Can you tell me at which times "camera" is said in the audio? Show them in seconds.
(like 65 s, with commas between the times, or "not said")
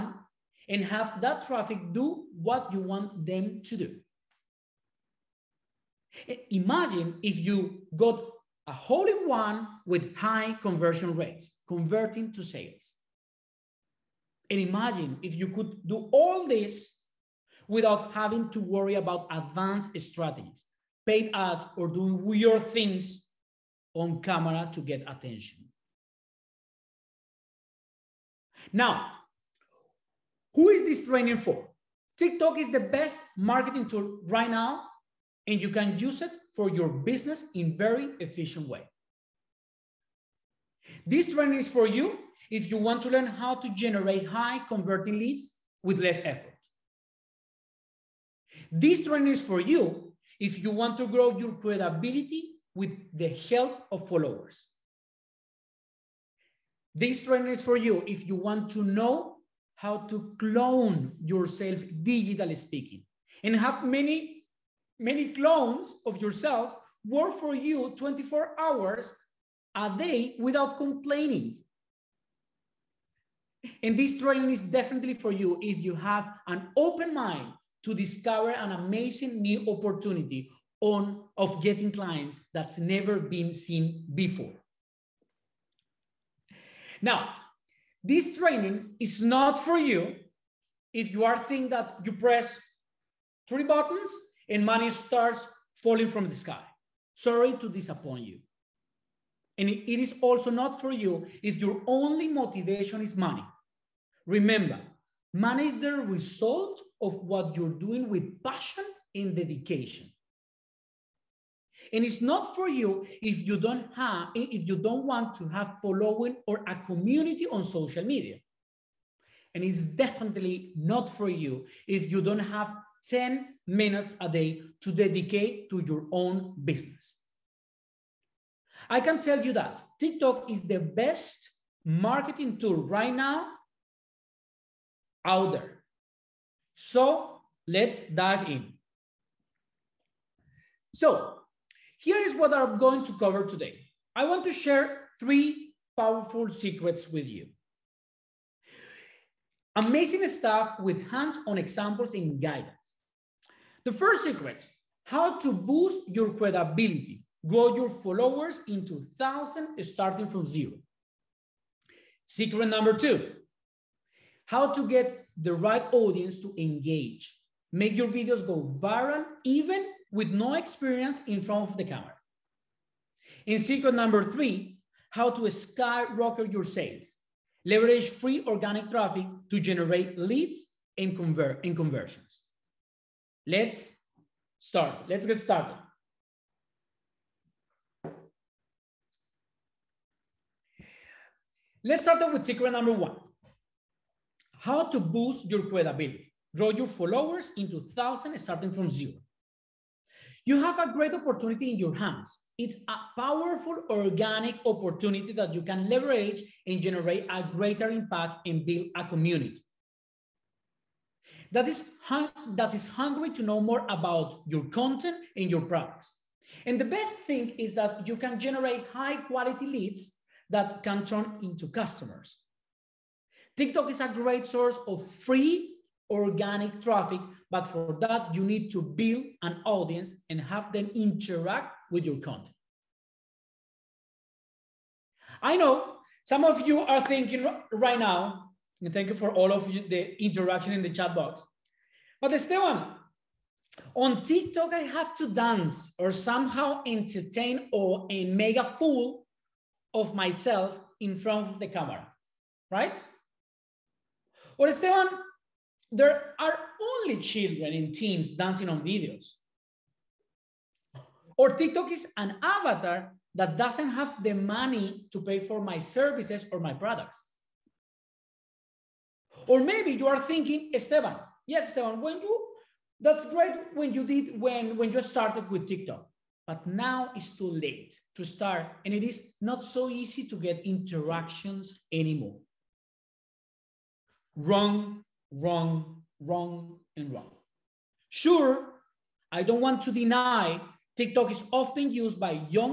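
24 s, 171 s, 251 s.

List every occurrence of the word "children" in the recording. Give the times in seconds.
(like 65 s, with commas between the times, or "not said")
257 s.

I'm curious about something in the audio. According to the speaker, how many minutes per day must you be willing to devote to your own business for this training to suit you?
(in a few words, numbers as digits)
10 minutes.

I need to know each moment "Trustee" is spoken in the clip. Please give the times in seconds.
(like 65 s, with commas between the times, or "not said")
not said.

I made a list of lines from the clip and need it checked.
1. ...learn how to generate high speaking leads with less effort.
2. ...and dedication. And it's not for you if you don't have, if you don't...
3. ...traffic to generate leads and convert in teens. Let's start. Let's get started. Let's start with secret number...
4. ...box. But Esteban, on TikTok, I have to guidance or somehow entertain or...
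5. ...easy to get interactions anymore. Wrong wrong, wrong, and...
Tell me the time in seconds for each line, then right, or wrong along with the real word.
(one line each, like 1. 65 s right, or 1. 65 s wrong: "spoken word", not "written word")
1. 43 s wrong: "converting", not "speaking"
2. 109 s right
3. 178 s wrong: "conversions", not "teens"
4. 241 s wrong: "dance", not "guidance"
5. 279 s right.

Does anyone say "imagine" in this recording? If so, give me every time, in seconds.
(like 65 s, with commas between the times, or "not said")
6 s, 14 s.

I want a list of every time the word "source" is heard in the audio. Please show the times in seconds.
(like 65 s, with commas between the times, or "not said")
224 s.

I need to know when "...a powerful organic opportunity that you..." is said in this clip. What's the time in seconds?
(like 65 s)
202 s.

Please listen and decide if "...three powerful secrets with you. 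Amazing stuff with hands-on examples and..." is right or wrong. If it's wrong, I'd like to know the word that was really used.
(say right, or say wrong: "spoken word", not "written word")
right.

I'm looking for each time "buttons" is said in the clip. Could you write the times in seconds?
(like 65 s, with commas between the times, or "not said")
93 s.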